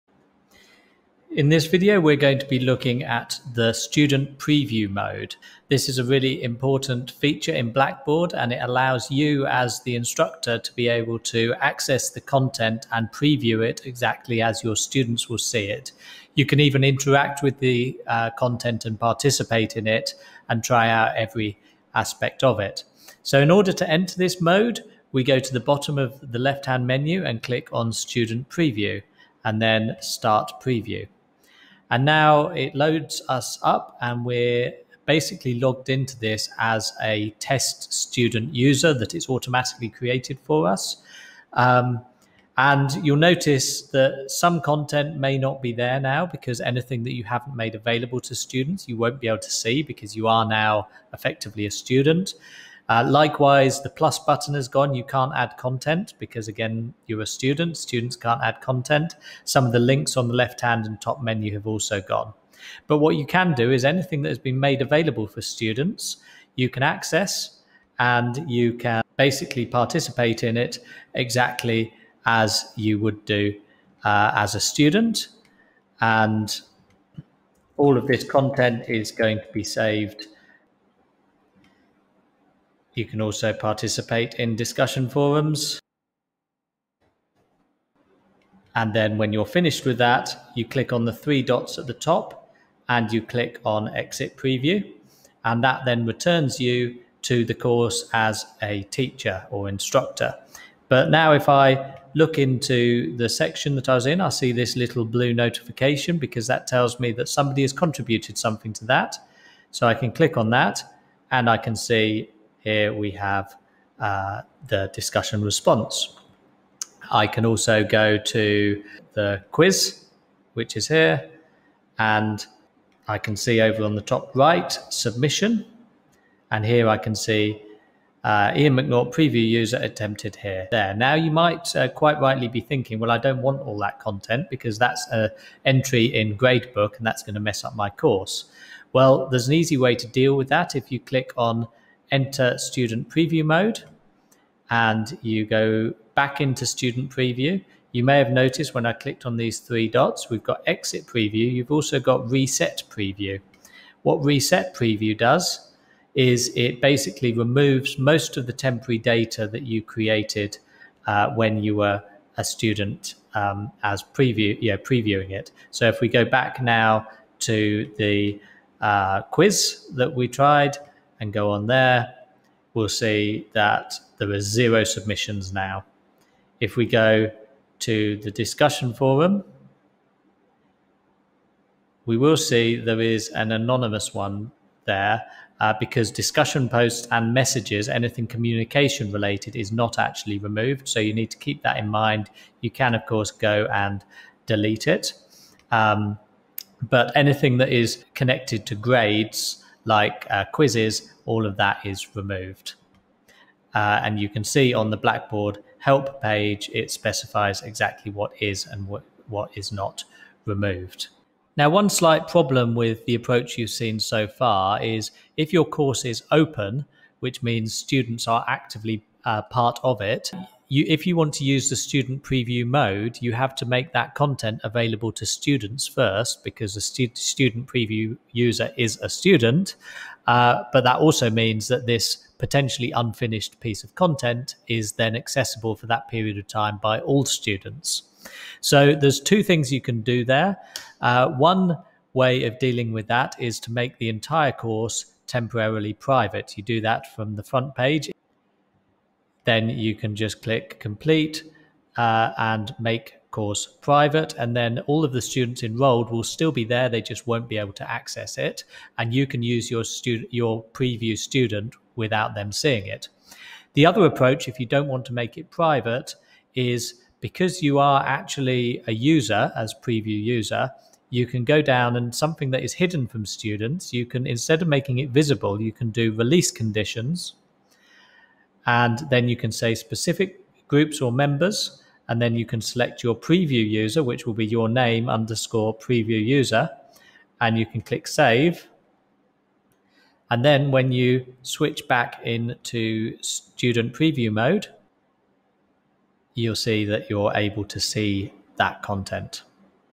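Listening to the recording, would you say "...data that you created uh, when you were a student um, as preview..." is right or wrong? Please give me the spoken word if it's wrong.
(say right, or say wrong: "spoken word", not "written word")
right.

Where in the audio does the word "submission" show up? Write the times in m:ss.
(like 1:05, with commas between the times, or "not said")
2:04, 2:54.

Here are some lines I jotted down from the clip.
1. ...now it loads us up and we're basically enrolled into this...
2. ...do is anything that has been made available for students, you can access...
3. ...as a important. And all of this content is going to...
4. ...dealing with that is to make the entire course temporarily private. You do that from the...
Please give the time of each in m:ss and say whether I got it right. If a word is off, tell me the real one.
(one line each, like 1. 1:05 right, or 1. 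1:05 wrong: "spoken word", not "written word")
1. 0:32 wrong: "logged", not "enrolled"
2. 1:03 right
3. 1:14 wrong: "student", not "important"
4. 4:02 right.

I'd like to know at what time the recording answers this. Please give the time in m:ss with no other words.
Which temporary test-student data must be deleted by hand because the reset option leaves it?
3:06.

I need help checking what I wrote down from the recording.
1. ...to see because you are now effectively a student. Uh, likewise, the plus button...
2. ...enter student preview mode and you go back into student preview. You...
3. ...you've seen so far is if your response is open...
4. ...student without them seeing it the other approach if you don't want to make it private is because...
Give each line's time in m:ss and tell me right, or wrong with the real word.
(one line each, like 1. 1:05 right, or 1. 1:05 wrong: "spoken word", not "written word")
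1. 0:49 right
2. 2:22 right
3. 3:33 wrong: "course", not "response"
4. 4:21 right.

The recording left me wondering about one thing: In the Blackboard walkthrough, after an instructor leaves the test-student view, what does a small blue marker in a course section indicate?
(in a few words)
Somebody has contributed something.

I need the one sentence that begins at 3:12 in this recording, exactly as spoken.
You can, of course, go and delete it.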